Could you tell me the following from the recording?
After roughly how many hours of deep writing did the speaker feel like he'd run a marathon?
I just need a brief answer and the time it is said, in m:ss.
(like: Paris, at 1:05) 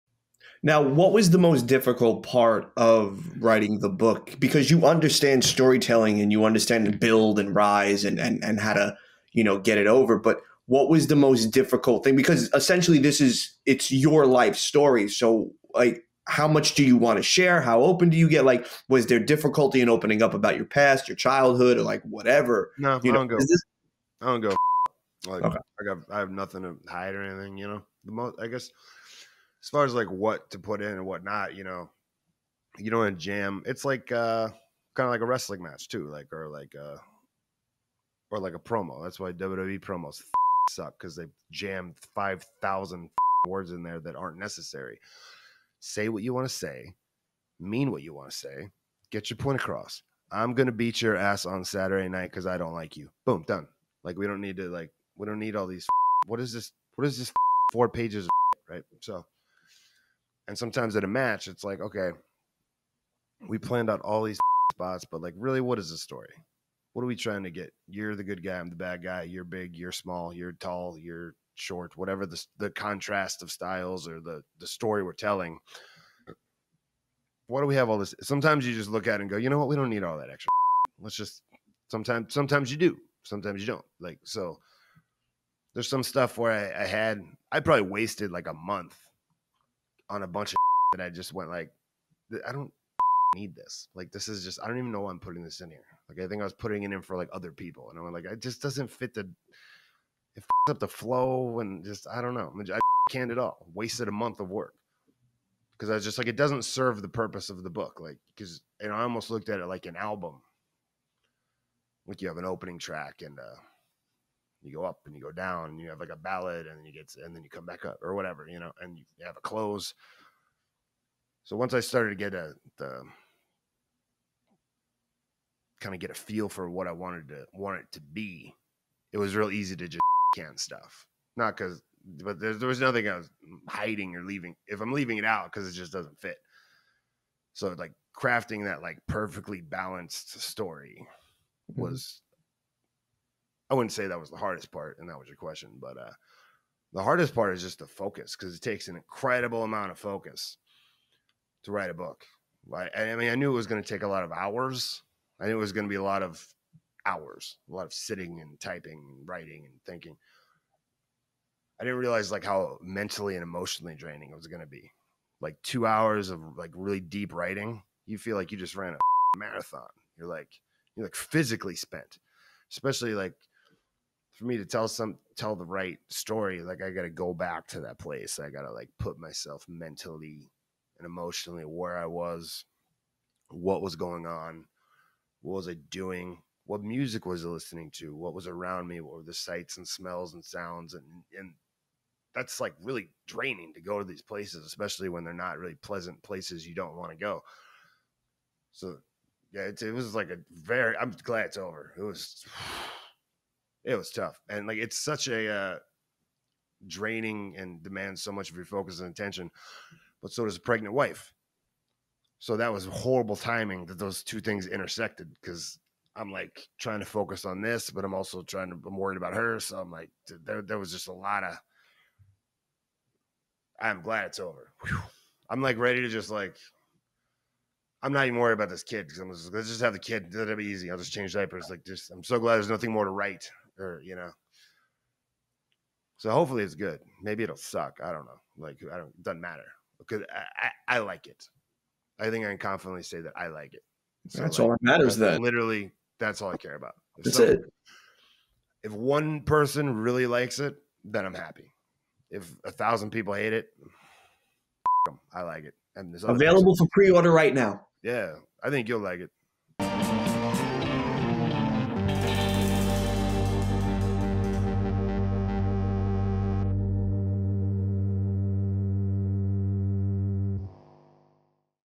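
2, at 2:45.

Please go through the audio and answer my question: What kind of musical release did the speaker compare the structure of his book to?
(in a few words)
an album.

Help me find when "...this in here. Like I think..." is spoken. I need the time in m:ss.
1:35.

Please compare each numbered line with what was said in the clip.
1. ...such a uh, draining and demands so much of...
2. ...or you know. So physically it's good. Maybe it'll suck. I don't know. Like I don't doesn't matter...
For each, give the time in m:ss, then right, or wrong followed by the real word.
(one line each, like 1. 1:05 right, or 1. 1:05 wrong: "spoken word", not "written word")
1. 3:24 right
2. 3:53 wrong: "hopefully", not "physically".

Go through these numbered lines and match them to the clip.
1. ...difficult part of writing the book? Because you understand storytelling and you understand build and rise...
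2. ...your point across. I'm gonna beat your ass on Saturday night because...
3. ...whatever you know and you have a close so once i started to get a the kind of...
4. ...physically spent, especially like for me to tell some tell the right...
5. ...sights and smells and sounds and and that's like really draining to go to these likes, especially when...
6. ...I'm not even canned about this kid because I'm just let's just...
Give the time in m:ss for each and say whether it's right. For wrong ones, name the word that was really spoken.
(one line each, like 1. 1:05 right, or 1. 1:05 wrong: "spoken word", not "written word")
1. 0:01 right
2. 0:49 right
3. 1:58 right
4. 2:51 right
5. 3:09 wrong: "places", not "likes"
6. 3:48 wrong: "worried", not "canned".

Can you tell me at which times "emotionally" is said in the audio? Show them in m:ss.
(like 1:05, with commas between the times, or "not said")
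2:43, 3:01.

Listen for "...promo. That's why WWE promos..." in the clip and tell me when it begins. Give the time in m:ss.
0:38.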